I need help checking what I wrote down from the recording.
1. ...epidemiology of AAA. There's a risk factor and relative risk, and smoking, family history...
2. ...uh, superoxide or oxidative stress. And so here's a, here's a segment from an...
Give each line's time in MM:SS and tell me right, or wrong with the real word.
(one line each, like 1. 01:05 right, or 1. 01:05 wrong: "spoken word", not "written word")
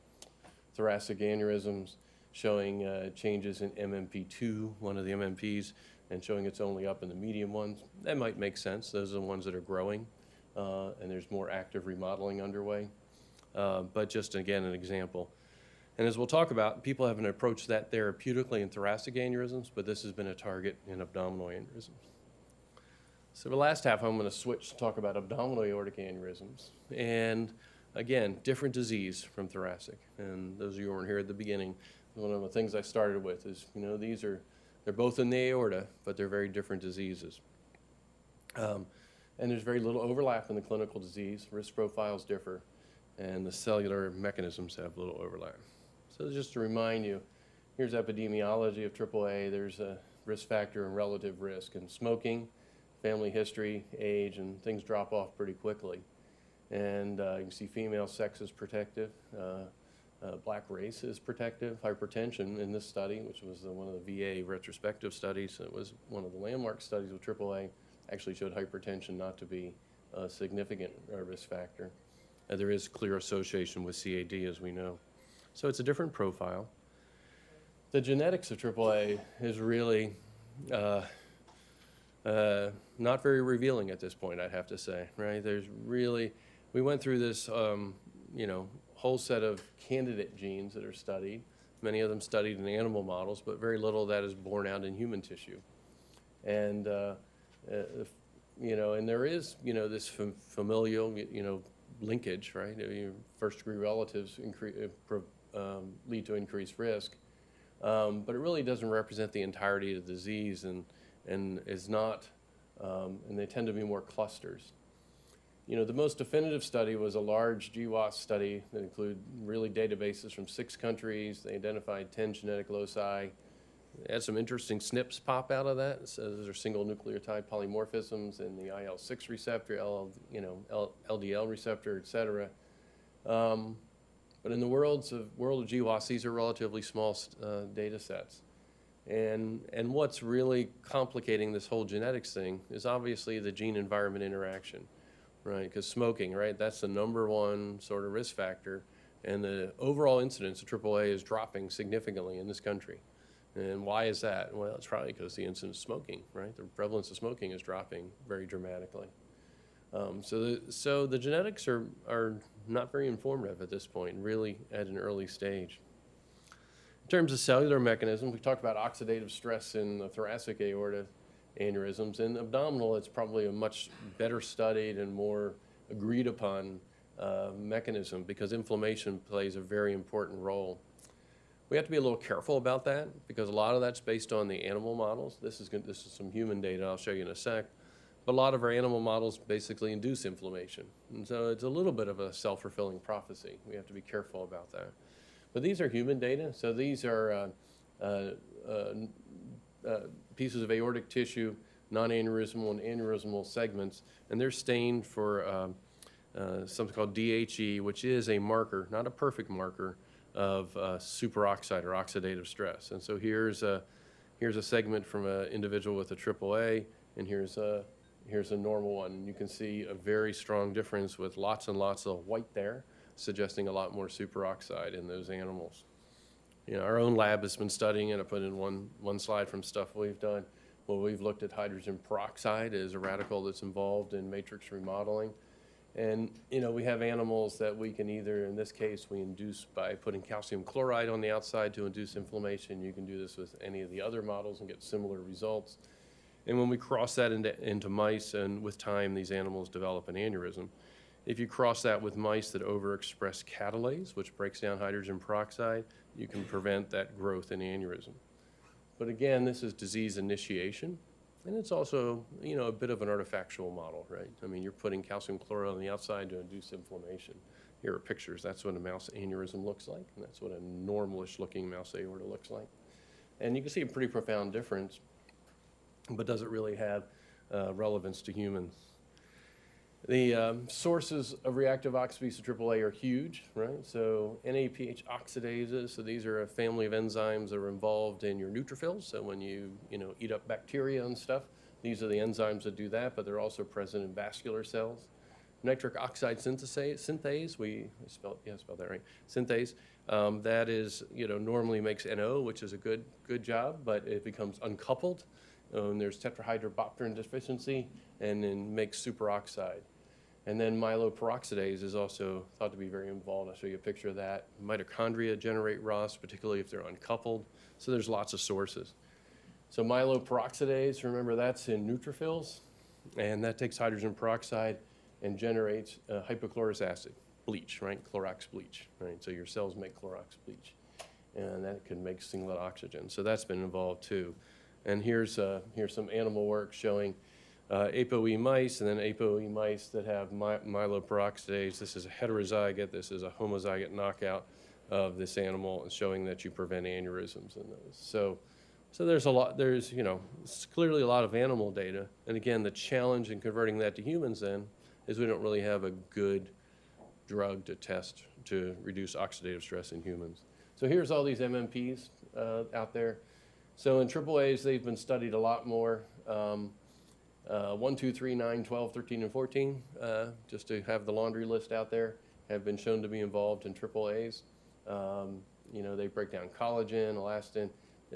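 1. 00:47 right
2. 03:30 right.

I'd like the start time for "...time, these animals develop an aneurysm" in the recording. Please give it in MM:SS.
04:08.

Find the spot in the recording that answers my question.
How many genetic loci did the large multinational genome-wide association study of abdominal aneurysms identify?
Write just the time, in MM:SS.
02:02.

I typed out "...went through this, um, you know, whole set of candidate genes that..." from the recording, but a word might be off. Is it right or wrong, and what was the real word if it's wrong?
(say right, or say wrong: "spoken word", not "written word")
right.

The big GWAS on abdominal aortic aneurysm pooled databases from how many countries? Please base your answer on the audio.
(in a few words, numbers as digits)
6.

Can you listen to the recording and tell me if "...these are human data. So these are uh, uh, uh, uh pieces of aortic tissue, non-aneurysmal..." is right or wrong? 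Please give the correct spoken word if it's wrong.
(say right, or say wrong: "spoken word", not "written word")
right.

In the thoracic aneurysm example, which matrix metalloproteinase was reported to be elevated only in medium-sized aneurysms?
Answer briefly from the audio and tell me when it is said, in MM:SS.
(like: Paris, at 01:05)
MMP2, at 00:03.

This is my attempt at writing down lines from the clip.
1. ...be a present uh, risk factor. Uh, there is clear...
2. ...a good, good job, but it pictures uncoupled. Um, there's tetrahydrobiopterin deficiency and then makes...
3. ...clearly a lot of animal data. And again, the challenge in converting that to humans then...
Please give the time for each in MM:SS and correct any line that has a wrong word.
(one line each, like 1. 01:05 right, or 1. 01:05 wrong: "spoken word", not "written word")
1. 01:09 wrong: "significant", not "present"
2. 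05:02 wrong: "becomes", not "pictures"
3. 05:50 right.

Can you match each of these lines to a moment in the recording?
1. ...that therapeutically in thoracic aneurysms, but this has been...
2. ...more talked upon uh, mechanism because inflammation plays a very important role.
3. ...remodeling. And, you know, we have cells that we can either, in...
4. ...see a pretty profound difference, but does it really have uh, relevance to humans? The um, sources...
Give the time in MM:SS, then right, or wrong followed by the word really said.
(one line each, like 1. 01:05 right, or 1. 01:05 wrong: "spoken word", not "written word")
1. 00:17 right
2. 02:55 wrong: "agreed", not "talked"
3. 03:54 wrong: "animals", not "cells"
4. 04:33 right.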